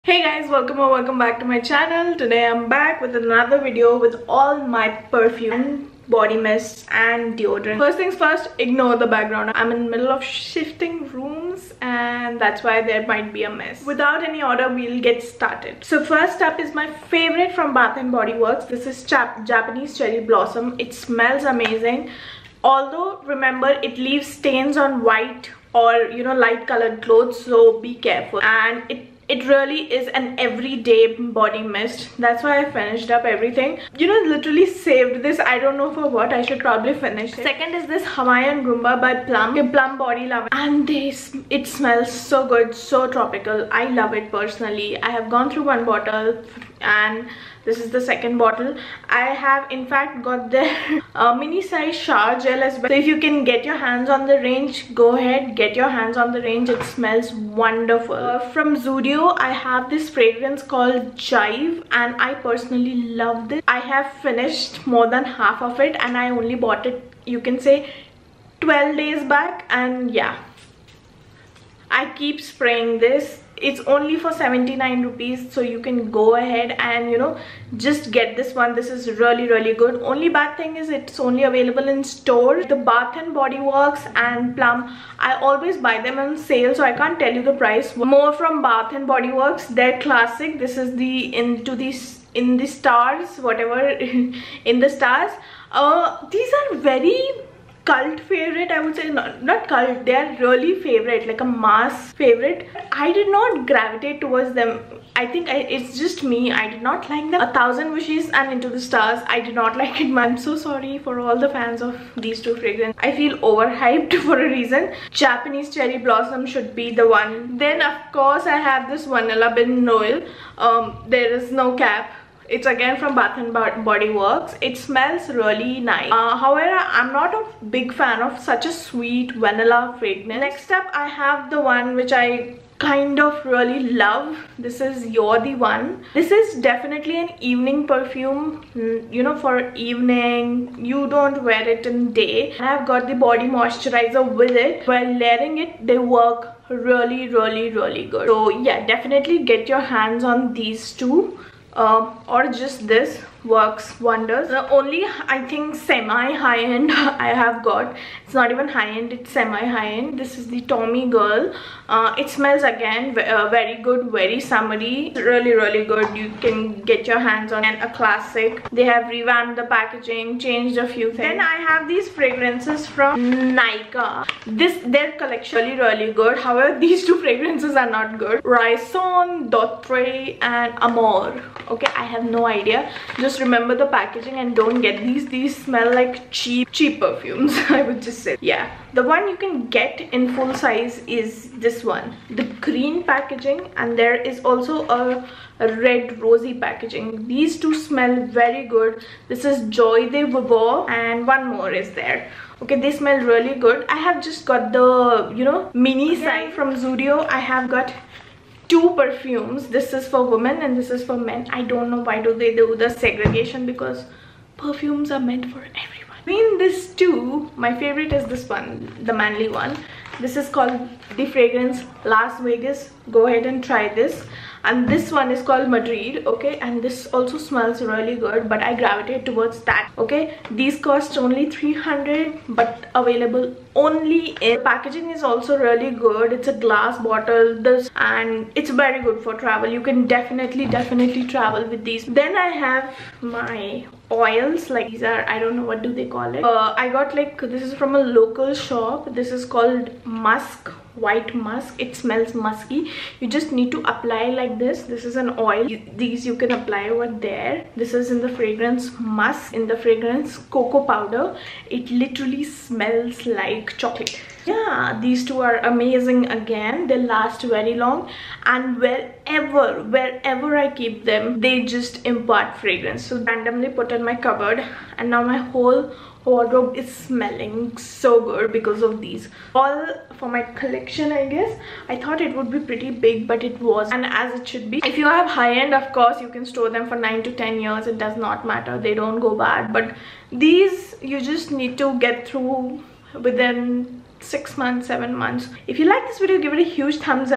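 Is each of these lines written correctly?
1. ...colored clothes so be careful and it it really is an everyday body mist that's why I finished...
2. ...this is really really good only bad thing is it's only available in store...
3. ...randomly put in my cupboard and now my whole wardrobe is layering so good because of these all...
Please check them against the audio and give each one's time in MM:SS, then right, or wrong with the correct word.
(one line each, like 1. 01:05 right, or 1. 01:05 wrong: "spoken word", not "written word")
1. 00:26 right
2. 01:18 right
3. 04:33 wrong: "smelling", not "layering".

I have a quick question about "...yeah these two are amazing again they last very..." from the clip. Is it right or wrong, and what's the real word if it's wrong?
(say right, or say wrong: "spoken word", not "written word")
right.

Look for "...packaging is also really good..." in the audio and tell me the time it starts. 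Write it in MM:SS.
03:54.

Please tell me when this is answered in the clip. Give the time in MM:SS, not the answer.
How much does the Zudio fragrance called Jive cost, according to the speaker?
01:14.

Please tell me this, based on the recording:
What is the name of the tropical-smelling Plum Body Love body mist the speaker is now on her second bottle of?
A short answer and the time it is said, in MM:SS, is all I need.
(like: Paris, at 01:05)
Hawaiian Rumba, at 00:38.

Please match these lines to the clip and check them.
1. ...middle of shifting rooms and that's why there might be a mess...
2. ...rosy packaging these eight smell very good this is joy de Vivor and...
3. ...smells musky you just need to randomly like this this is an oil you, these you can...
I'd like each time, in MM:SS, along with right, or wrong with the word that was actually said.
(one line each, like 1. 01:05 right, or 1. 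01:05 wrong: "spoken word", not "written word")
1. 00:09 right
2. 03:16 wrong: "two", not "eight"
3. 04:11 wrong: "apply", not "randomly".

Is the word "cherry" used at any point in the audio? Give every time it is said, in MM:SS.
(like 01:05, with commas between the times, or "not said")
00:19, 01:55.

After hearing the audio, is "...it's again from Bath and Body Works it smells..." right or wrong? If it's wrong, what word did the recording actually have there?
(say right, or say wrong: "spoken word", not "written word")
right.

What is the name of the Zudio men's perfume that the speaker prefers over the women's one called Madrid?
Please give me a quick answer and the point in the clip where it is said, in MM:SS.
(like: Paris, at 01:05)
Las Vegas, at 03:42.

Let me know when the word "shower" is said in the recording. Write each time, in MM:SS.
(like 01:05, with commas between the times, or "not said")
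00:51.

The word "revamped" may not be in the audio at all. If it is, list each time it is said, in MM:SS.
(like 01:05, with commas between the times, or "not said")
02:49.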